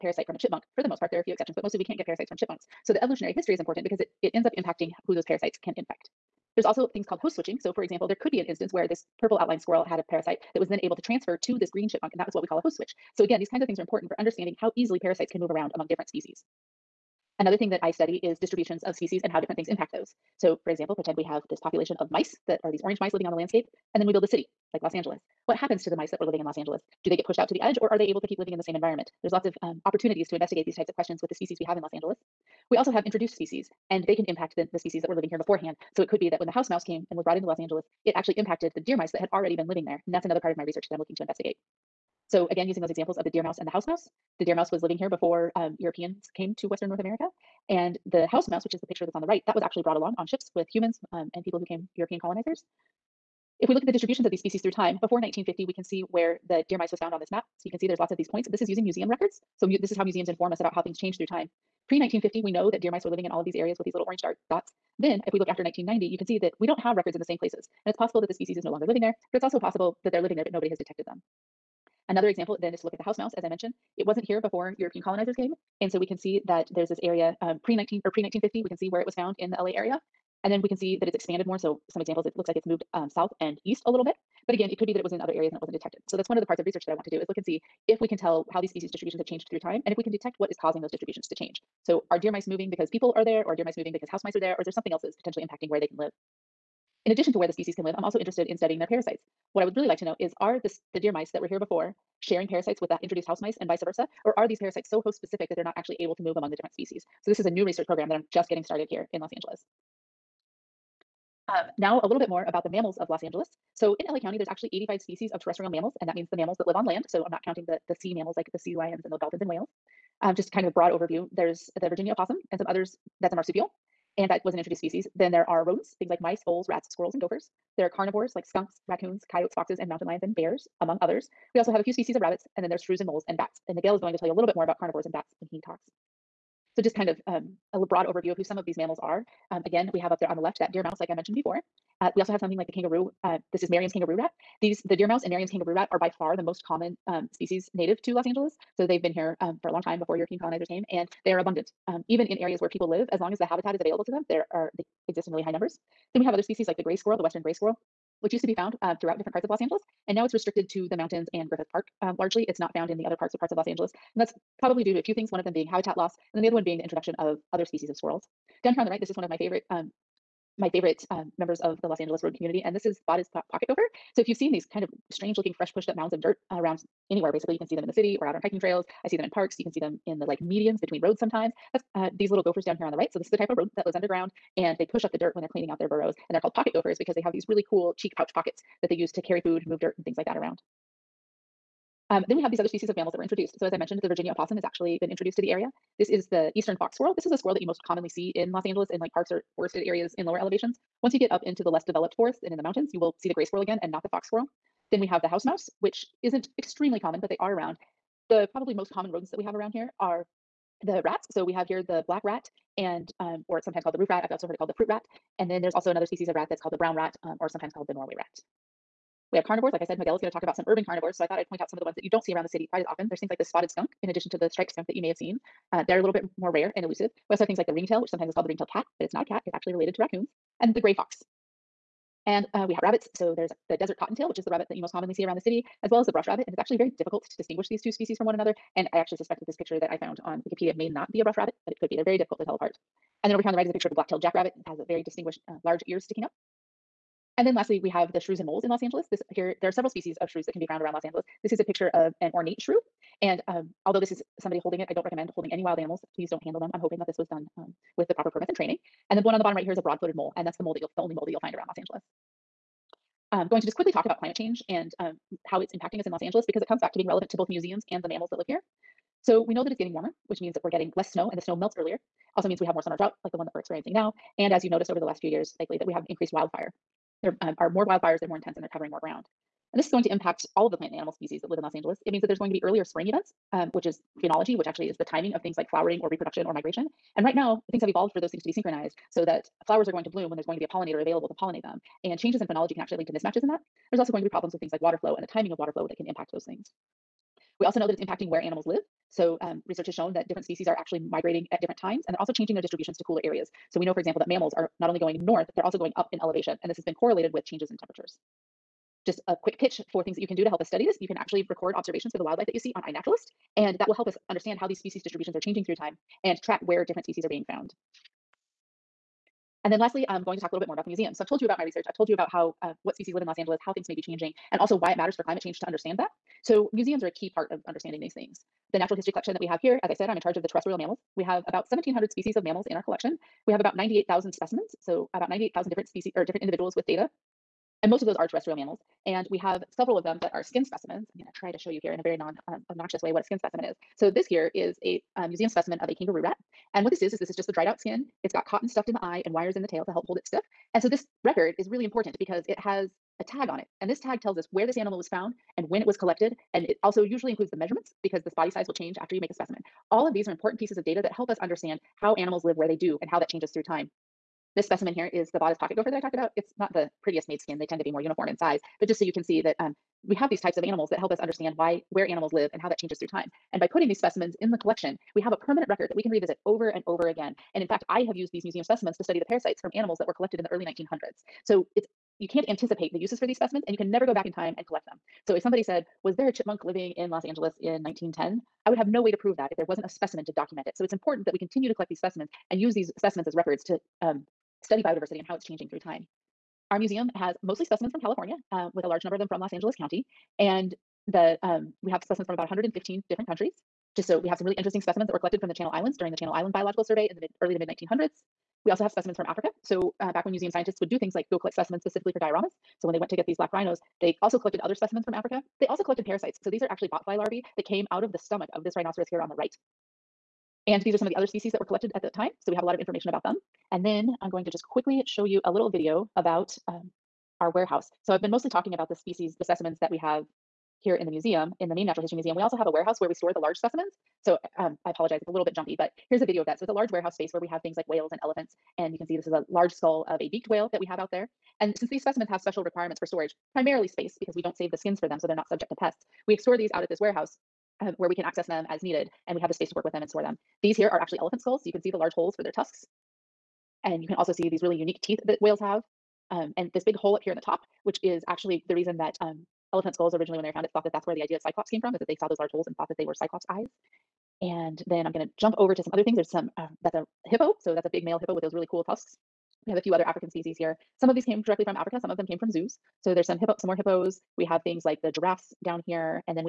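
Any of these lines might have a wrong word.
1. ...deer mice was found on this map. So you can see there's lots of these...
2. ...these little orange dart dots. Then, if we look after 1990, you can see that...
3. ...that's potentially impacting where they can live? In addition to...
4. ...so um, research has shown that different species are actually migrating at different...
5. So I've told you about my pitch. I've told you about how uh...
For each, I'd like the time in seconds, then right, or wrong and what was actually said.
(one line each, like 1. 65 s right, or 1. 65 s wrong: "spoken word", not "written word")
1. 56 s right
2. 63 s right
3. 95 s right
4. 299 s right
5. 321 s wrong: "research", not "pitch".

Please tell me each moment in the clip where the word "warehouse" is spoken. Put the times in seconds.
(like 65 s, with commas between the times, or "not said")
427 s, 432 s, 436 s, 447 s.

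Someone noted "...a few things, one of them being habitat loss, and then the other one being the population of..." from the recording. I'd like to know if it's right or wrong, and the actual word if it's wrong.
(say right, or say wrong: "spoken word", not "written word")
wrong: "introduction", not "population".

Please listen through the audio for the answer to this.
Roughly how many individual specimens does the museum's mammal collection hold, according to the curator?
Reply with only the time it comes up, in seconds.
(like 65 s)
333 s.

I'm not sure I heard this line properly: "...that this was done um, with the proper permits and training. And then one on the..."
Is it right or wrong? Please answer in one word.
right.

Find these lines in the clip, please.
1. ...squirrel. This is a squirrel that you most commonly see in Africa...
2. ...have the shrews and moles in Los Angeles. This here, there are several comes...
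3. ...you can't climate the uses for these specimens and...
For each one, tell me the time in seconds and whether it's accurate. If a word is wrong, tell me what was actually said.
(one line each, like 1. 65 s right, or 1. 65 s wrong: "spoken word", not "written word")
1. 196 s wrong: "Los", not "Africa"
2. 247 s wrong: "species", not "comes"
3. 382 s wrong: "anticipate", not "climate".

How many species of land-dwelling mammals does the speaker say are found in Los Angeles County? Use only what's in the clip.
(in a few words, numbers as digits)
85.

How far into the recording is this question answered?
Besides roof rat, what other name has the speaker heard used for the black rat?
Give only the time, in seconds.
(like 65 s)
214 s.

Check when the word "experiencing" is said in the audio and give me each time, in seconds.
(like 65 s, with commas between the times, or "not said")
273 s.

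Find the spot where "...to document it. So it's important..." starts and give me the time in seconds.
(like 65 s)
390 s.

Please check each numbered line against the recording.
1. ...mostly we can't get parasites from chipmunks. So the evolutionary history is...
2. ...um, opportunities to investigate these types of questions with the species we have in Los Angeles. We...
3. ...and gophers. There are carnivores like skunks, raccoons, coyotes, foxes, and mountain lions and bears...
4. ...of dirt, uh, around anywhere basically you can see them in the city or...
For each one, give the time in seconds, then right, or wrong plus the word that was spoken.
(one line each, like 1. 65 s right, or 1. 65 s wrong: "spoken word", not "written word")
1. 1 s right
2. 29 s right
3. 127 s right
4. 176 s right.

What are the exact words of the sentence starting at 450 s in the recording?
These here are actually elephant skulls, so you can see the large holes for their tusks.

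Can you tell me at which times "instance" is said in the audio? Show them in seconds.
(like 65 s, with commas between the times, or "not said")
8 s.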